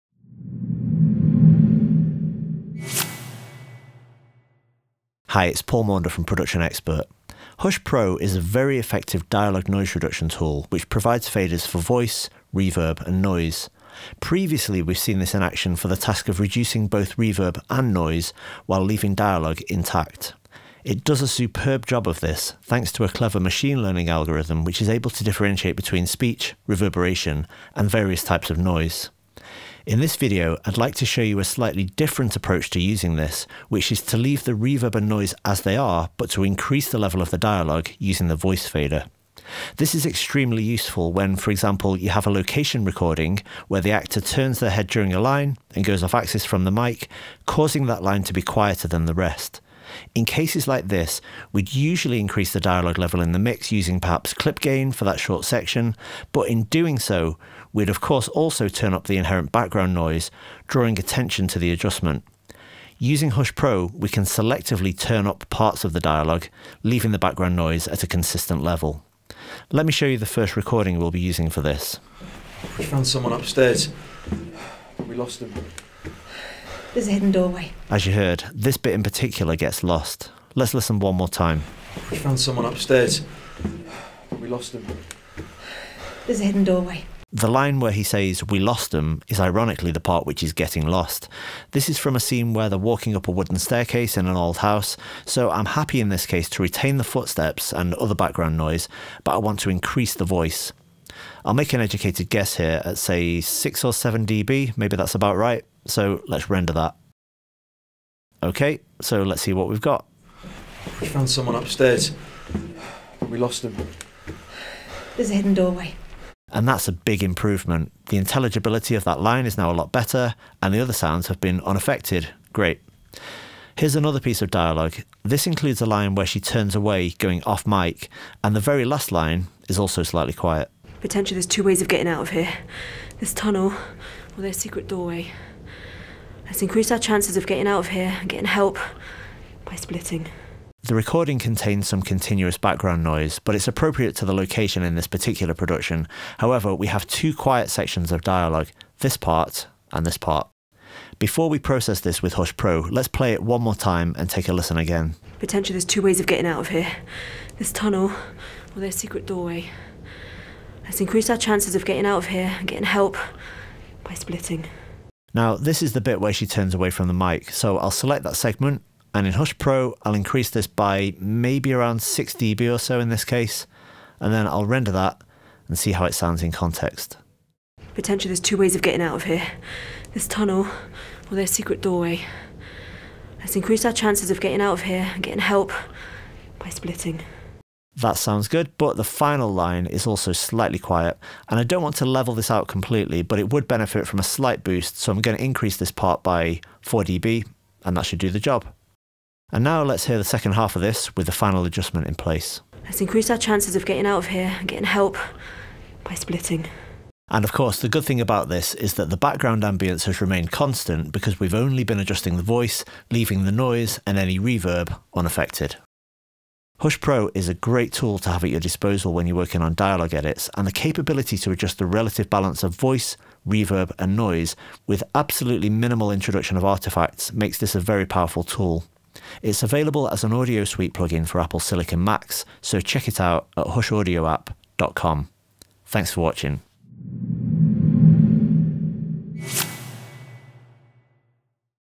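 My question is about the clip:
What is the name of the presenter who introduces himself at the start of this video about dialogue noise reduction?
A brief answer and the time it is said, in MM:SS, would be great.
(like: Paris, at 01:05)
Paul Maunder, at 00:05.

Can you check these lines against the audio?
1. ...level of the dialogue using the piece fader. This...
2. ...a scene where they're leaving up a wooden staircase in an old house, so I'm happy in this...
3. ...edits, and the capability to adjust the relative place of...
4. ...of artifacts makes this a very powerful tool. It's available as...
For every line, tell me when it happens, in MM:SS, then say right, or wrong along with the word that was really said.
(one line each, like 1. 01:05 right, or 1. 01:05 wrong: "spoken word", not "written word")
1. 00:36 wrong: "voice", not "piece"
2. 01:32 wrong: "walking", not "leaving"
3. 03:40 wrong: "balance", not "place"
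4. 03:46 right.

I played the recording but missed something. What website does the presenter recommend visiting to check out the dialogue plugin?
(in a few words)
hushaudioapp.com.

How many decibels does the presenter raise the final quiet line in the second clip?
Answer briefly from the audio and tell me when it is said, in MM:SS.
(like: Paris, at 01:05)
4 dB, at 03:16.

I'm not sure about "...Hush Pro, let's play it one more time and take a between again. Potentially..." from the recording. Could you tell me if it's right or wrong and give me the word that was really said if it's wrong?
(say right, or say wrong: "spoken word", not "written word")
wrong: "listen", not "between".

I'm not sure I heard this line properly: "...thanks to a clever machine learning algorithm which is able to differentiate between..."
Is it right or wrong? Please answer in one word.
right.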